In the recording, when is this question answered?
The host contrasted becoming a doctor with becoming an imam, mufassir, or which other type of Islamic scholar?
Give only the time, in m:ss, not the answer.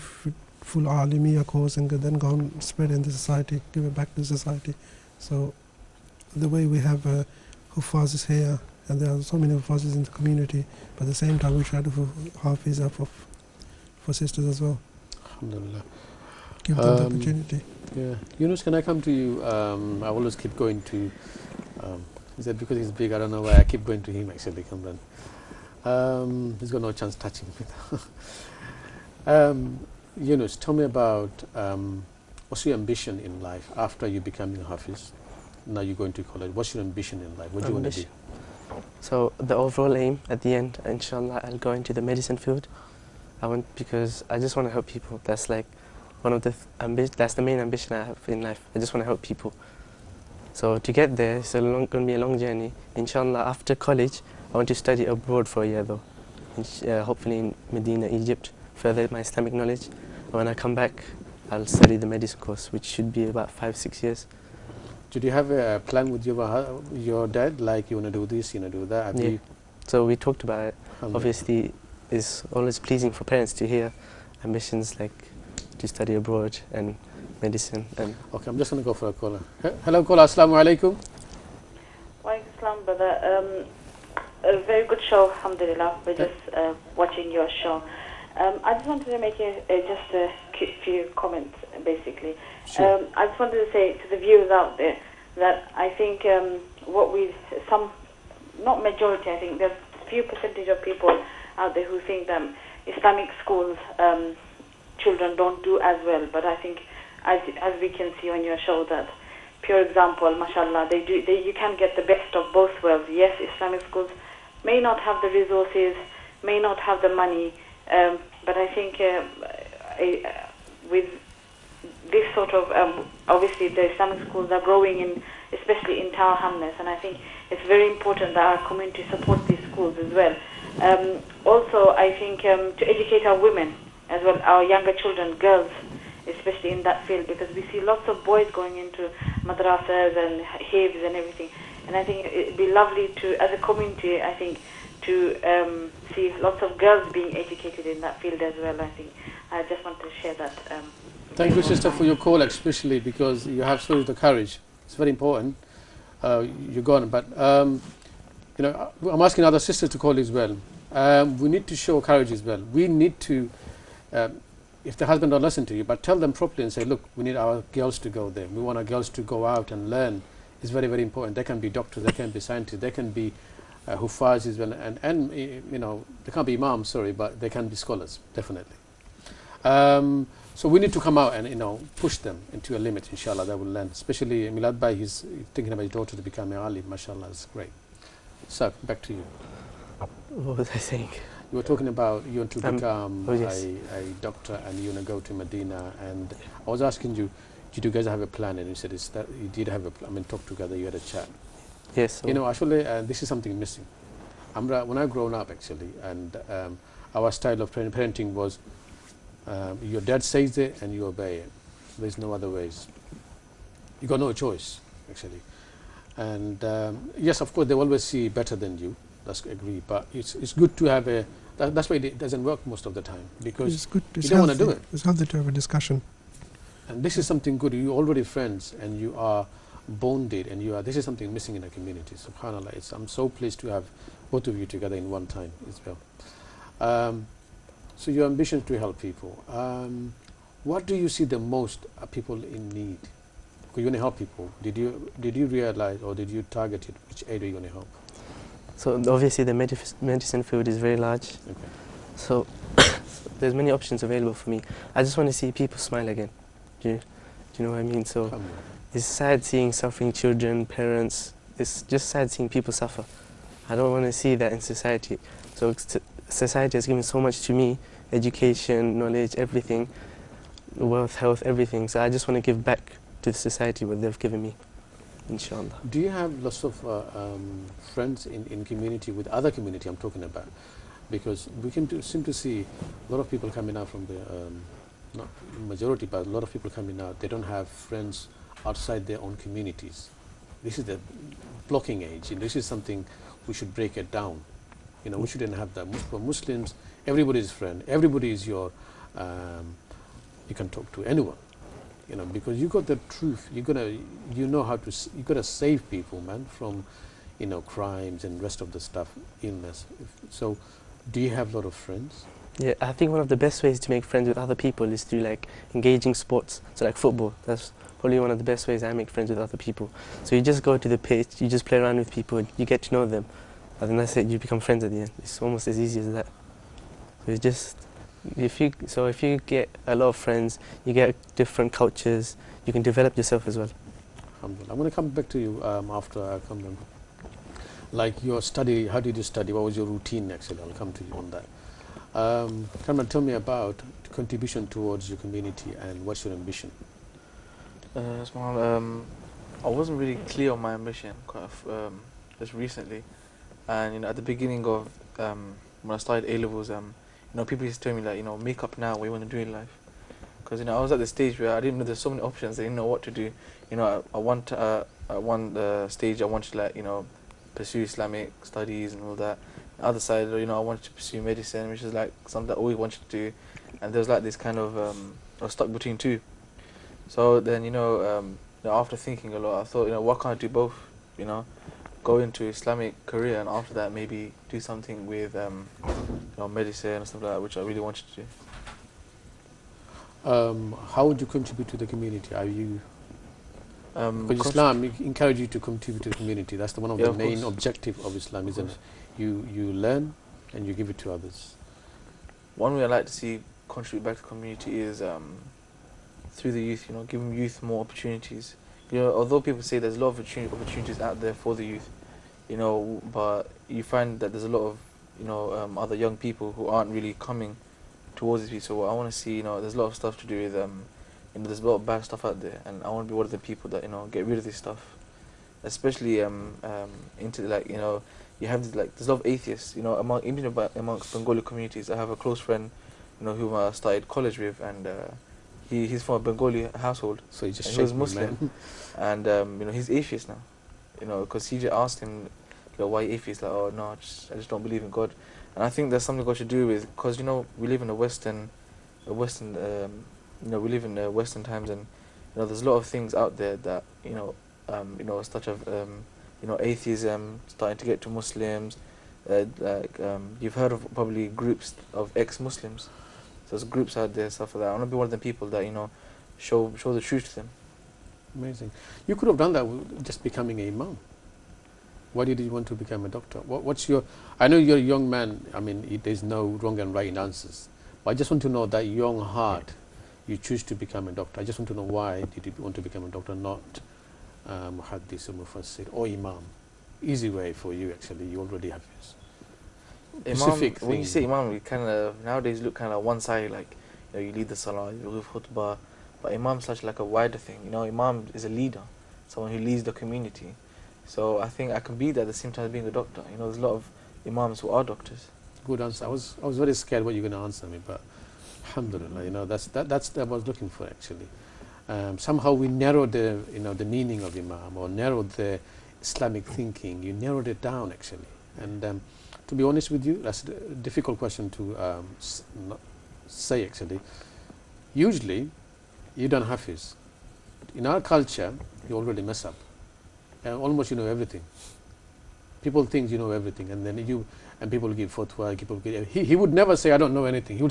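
8:04.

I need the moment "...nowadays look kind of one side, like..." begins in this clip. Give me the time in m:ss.
8:12.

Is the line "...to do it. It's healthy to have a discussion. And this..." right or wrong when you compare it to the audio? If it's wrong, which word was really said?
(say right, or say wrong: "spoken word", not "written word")
right.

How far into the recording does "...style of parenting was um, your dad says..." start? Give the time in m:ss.
3:27.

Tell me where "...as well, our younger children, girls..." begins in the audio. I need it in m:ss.
2:14.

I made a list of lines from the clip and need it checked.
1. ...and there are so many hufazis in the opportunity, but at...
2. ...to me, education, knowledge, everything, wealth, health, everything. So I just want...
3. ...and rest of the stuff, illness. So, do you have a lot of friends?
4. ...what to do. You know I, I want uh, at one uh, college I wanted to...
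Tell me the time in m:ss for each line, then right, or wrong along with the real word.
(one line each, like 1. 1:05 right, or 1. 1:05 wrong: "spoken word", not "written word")
1. 0:08 wrong: "community", not "opportunity"
2. 4:27 right
3. 5:08 right
4. 6:02 wrong: "stage", not "college".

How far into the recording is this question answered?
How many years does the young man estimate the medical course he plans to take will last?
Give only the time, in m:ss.
1:03.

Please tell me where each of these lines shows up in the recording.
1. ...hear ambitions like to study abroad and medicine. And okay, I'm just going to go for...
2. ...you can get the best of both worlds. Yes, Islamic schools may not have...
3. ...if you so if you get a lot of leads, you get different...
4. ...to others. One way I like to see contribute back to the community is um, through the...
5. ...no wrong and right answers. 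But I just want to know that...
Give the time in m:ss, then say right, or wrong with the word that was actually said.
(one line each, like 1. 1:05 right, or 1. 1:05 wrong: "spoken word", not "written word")
1. 1:13 right
2. 1:51 right
3. 5:28 wrong: "friends", not "leads"
4. 6:40 right
5. 7:56 right.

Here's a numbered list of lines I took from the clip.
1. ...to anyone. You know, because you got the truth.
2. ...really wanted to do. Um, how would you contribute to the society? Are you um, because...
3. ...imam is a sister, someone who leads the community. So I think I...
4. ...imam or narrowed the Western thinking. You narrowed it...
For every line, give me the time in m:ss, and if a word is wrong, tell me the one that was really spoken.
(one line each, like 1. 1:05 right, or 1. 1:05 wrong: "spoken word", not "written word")
1. 5:00 right
2. 6:27 wrong: "community", not "society"
3. 8:17 wrong: "leader", not "sister"
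4. 8:34 wrong: "Islamic", not "Western".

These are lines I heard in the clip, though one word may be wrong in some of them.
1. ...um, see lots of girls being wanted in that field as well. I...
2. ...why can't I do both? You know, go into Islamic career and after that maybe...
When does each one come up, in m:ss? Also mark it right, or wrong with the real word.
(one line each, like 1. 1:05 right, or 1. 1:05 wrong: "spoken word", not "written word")
1. 2:25 wrong: "educated", not "wanted"
2. 6:19 right.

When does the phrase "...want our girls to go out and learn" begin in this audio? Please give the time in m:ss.
2:48.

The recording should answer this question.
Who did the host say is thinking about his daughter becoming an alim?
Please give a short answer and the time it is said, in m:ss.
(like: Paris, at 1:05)
Milad Bhai, at 3:04.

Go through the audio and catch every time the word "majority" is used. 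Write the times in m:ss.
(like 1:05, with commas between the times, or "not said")
1:38, 4:45.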